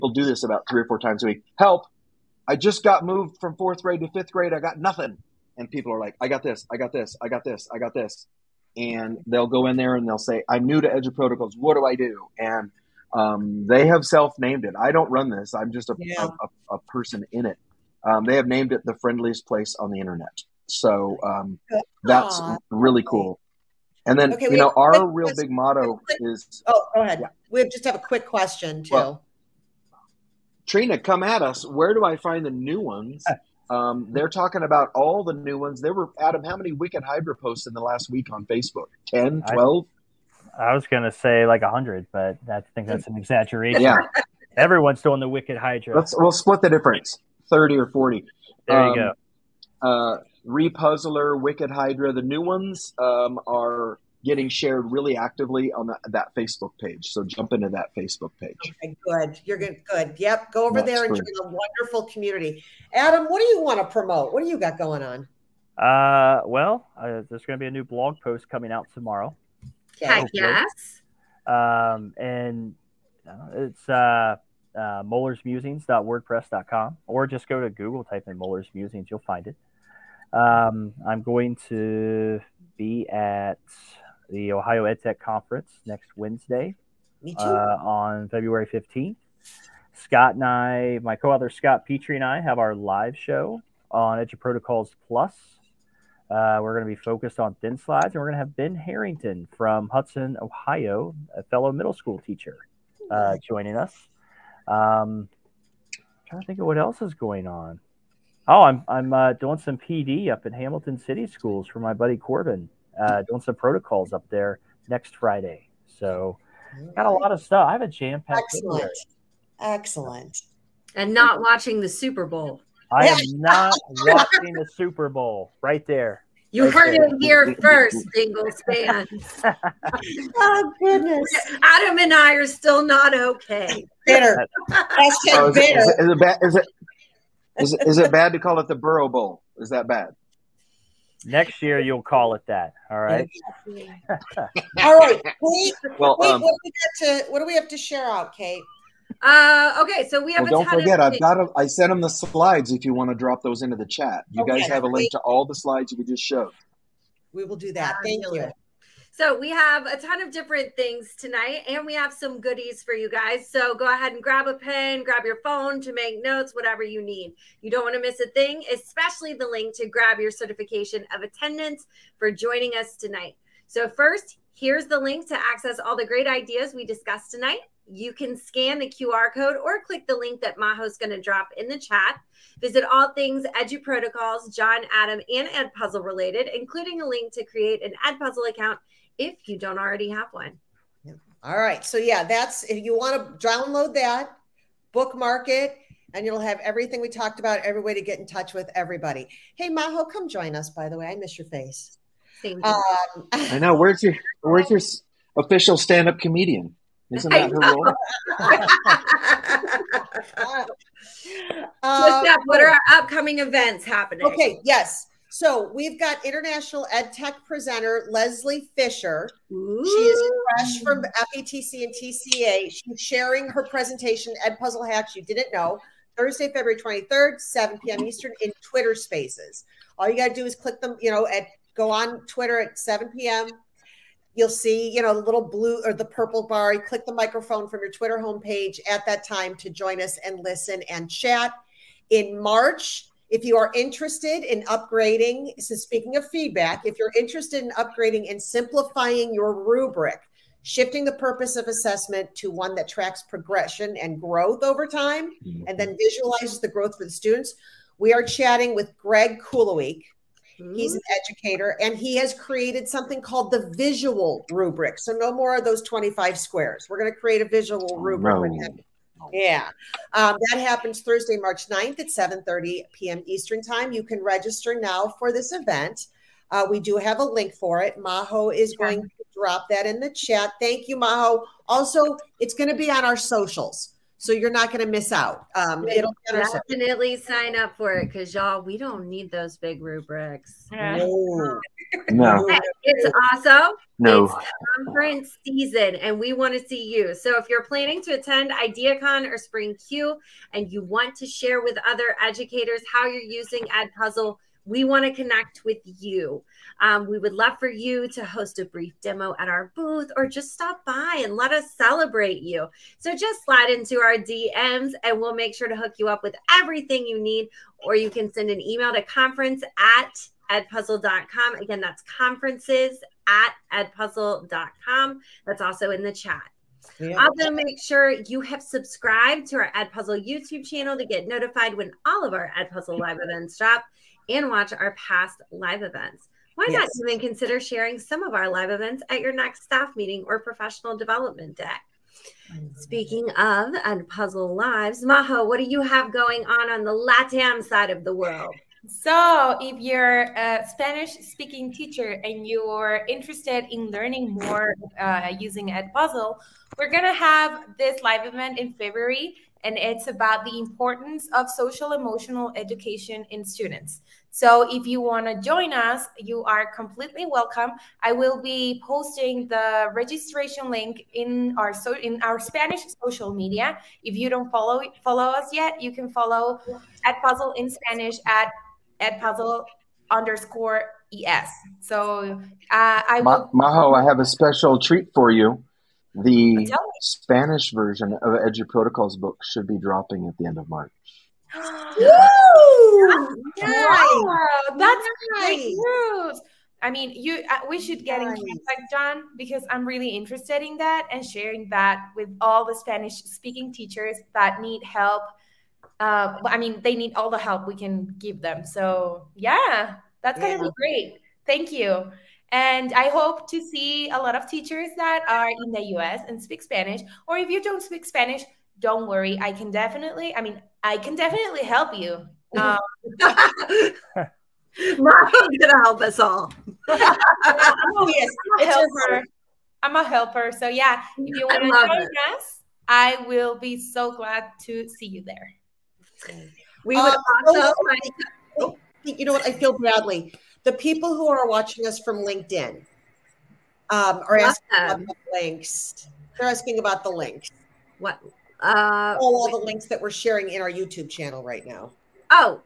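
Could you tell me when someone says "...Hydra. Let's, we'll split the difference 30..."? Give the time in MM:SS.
00:45.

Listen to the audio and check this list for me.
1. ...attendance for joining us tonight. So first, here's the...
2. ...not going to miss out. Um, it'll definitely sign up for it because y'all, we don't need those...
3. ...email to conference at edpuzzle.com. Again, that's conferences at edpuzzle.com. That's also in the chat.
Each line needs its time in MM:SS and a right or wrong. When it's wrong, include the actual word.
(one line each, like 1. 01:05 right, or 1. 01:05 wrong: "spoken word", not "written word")
1. 02:51 right
2. 04:44 right
3. 05:18 right.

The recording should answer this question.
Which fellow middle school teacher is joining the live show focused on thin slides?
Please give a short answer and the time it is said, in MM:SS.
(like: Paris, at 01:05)
Ben Harrington, at 01:38.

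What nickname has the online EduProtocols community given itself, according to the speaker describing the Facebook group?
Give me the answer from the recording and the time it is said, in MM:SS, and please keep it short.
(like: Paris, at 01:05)
the friendliest place on the internet, at 00:18.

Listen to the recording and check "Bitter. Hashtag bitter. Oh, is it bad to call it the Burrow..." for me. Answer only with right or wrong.
right.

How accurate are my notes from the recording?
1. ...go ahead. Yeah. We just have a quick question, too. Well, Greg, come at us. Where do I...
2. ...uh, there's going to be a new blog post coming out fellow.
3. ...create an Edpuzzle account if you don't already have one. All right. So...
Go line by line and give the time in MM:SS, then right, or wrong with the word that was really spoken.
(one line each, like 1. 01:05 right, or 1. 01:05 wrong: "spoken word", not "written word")
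1. 00:26 wrong: "Trina", not "Greg"
2. 01:06 wrong: "tomorrow", not "fellow"
3. 03:07 right.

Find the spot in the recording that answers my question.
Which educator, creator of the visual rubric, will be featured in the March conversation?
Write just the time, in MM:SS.
04:18.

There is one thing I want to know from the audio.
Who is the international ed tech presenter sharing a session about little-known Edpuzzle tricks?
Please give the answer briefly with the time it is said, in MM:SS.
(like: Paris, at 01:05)
Leslie Fisher, at 03:38.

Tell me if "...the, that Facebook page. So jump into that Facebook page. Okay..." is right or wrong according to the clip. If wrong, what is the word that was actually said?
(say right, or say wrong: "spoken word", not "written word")
right.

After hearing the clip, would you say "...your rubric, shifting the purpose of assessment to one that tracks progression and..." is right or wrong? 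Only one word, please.
right.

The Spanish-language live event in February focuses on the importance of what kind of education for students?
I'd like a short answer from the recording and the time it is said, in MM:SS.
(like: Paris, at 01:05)
social emotional education, at 06:01.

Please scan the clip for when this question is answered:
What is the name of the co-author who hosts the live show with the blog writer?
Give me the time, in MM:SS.
01:31.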